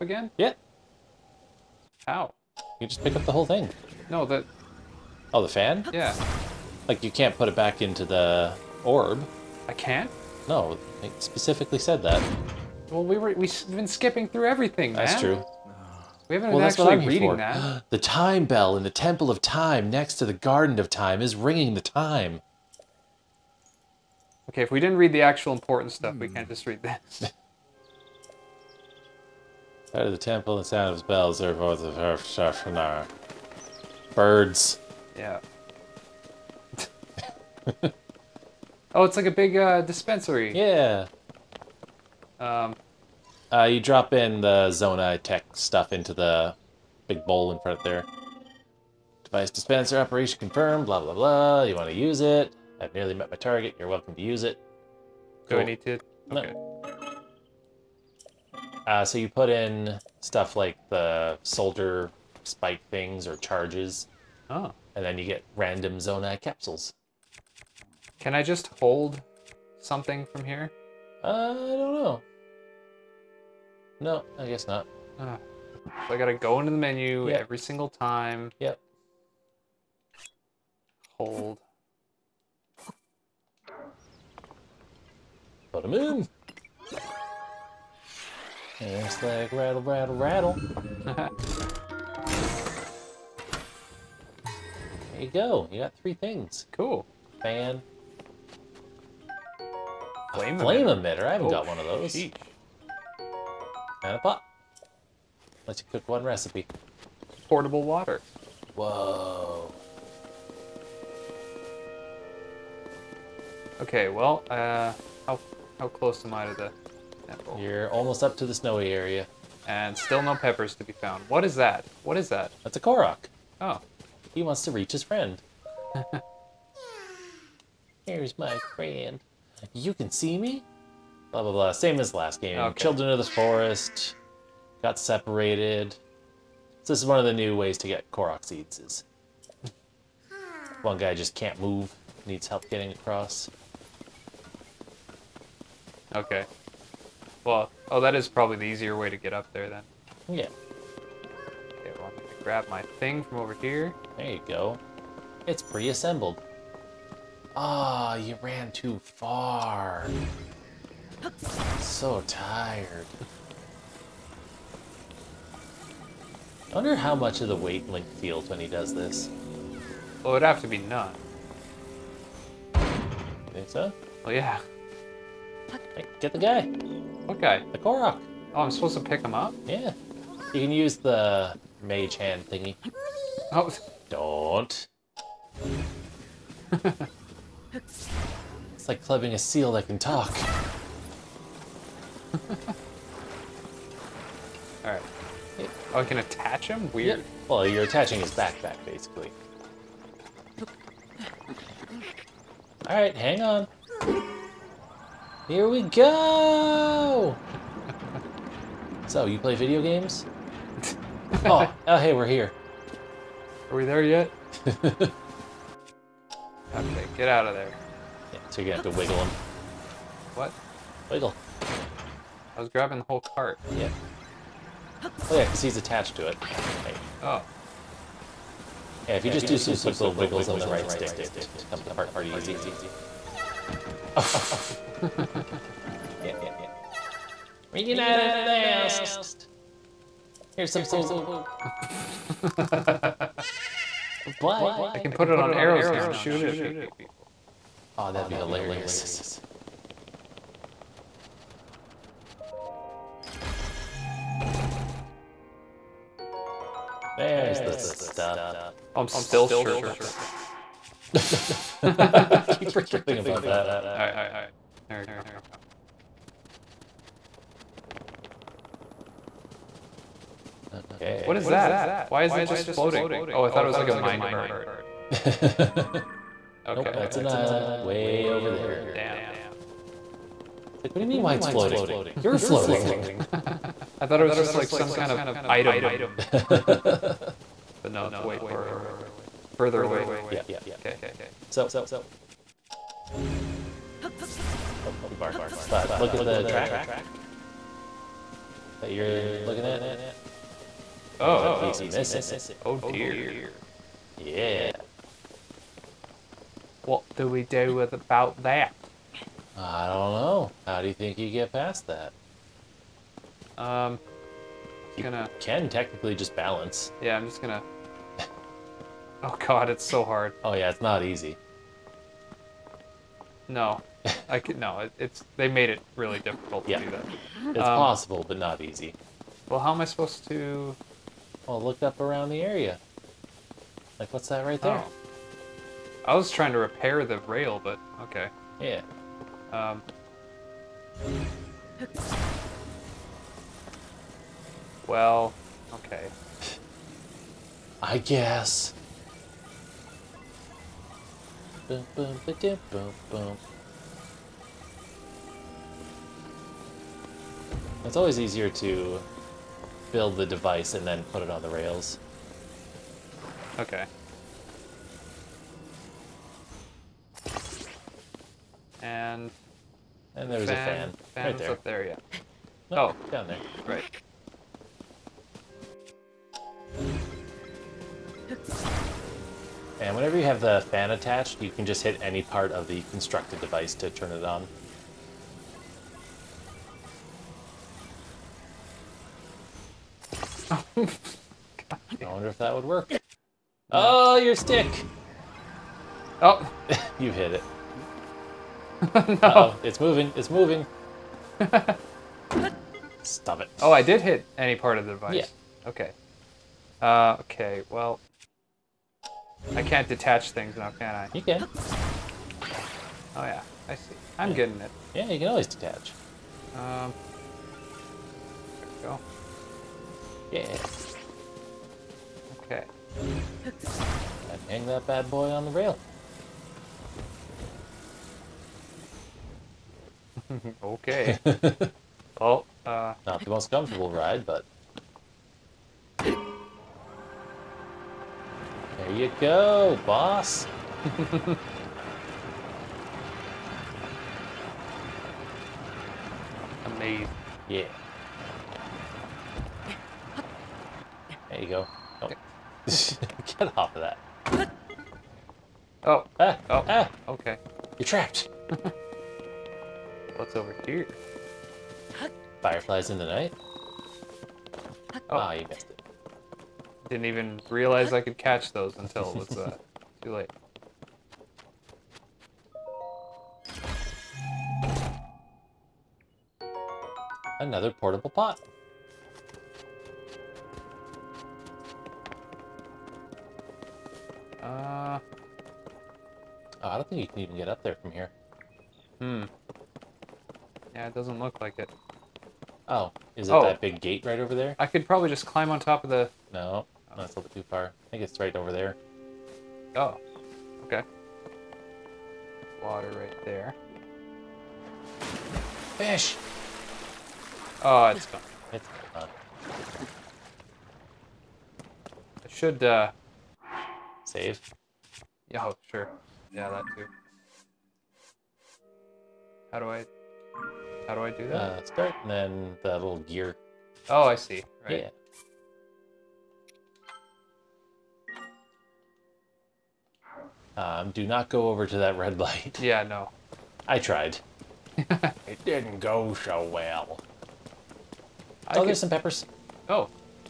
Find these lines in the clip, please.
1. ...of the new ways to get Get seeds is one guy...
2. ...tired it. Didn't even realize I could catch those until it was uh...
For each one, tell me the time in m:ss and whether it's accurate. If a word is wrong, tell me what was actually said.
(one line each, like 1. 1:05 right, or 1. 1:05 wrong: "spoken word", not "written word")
1. 2:17 wrong: "Korok", not "Get"
2. 7:45 wrong: "missed", not "tired".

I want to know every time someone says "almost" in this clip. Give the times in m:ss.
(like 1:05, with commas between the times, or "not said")
1:57.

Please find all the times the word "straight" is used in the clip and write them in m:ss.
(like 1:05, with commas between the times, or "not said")
not said.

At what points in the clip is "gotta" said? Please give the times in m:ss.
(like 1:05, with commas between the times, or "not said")
1:16.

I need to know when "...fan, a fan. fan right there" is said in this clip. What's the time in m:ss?
6:10.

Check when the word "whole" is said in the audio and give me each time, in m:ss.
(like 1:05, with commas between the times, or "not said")
0:03, 3:43.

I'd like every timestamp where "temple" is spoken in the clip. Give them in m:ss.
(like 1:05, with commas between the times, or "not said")
0:18, 0:30.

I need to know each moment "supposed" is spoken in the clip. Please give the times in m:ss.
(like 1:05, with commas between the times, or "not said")
2:58, 5:29.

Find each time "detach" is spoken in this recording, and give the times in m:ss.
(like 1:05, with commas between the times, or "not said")
6:49, 6:55.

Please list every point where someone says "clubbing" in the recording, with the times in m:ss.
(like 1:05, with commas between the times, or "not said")
3:09.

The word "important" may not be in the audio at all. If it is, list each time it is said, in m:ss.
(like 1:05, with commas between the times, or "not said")
0:25.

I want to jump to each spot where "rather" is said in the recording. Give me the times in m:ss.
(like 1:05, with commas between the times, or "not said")
not said.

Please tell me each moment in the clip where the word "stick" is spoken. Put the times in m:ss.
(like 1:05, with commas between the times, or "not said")
3:50, 6:34.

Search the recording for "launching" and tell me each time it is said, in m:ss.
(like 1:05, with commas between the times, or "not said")
not said.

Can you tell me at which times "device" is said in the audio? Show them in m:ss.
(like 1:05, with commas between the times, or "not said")
0:49, 6:00, 6:23, 6:44.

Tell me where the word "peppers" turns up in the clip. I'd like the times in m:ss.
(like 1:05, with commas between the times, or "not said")
2:00, 8:58.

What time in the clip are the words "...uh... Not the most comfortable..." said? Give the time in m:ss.
7:12.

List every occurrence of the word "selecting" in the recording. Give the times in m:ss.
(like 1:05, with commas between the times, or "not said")
not said.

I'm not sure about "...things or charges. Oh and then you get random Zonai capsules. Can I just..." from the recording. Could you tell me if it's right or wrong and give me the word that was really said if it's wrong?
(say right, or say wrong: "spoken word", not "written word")
right.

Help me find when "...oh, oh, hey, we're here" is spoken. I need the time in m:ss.
3:31.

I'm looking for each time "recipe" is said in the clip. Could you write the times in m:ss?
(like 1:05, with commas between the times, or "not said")
1:46.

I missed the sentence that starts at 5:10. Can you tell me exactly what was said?
How do you think you get past that?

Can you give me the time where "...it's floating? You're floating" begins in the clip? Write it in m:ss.
4:41.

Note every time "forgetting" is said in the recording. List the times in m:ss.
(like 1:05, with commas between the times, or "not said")
4:22.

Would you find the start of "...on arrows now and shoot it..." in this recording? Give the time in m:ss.
4:05.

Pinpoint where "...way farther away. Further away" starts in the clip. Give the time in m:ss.
4:48.